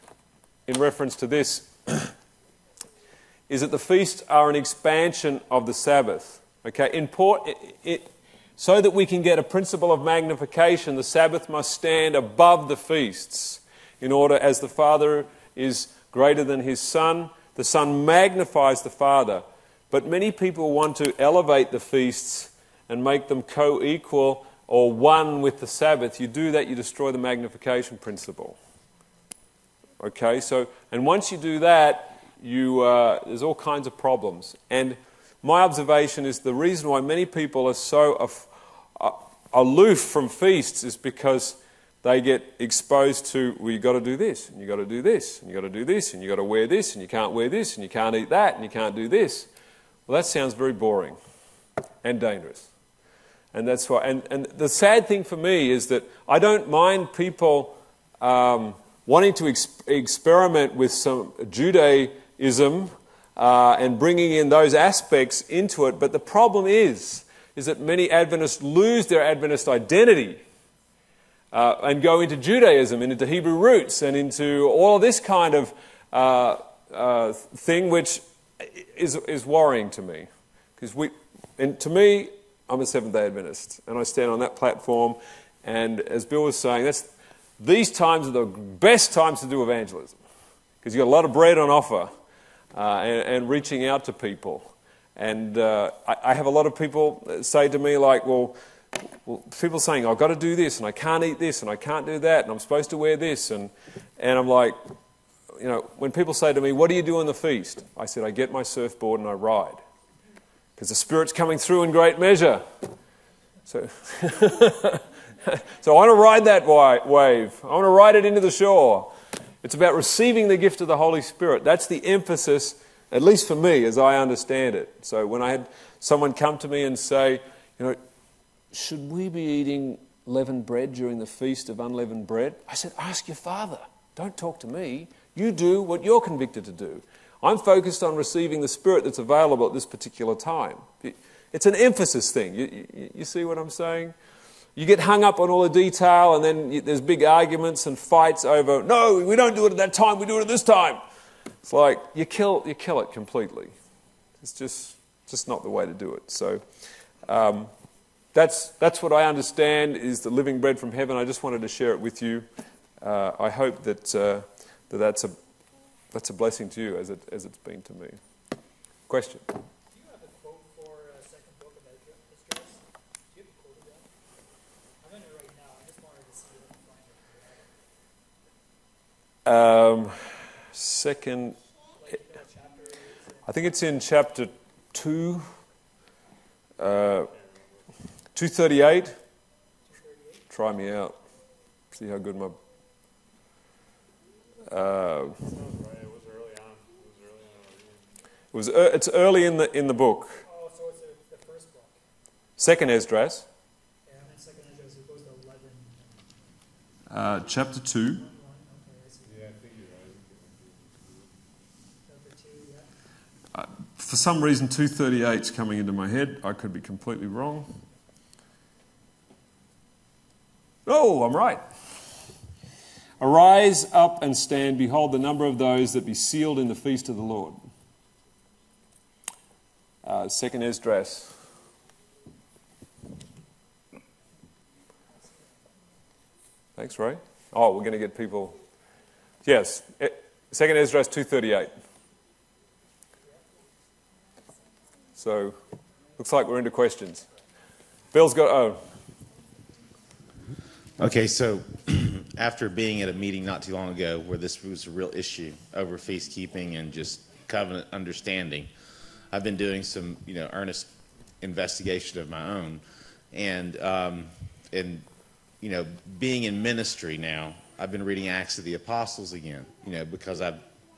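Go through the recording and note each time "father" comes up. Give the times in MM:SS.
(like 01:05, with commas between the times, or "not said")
00:14, 00:18, 02:13.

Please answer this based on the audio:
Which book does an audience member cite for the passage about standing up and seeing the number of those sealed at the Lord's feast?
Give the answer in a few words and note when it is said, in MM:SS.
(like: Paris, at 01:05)
Second Esdras, at 03:50.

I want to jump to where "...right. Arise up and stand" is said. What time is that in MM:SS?
03:41.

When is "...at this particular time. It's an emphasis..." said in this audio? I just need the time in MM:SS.
02:19.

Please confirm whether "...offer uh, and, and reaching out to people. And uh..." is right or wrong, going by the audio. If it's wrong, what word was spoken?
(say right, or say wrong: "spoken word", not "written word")
right.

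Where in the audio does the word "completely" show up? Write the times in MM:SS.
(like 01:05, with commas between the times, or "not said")
02:33, 03:36.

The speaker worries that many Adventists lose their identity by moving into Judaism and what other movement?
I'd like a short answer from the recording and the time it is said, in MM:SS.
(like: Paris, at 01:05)
Hebrew roots, at 01:13.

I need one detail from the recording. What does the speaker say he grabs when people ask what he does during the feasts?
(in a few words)
surfboard.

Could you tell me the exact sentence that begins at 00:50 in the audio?
Well, that sounds very boring and dangerous.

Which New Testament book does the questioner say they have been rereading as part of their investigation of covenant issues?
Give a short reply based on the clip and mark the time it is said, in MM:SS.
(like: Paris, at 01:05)
Acts of the Apostles, at 04:28.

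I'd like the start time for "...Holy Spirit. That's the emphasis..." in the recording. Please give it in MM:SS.
02:00.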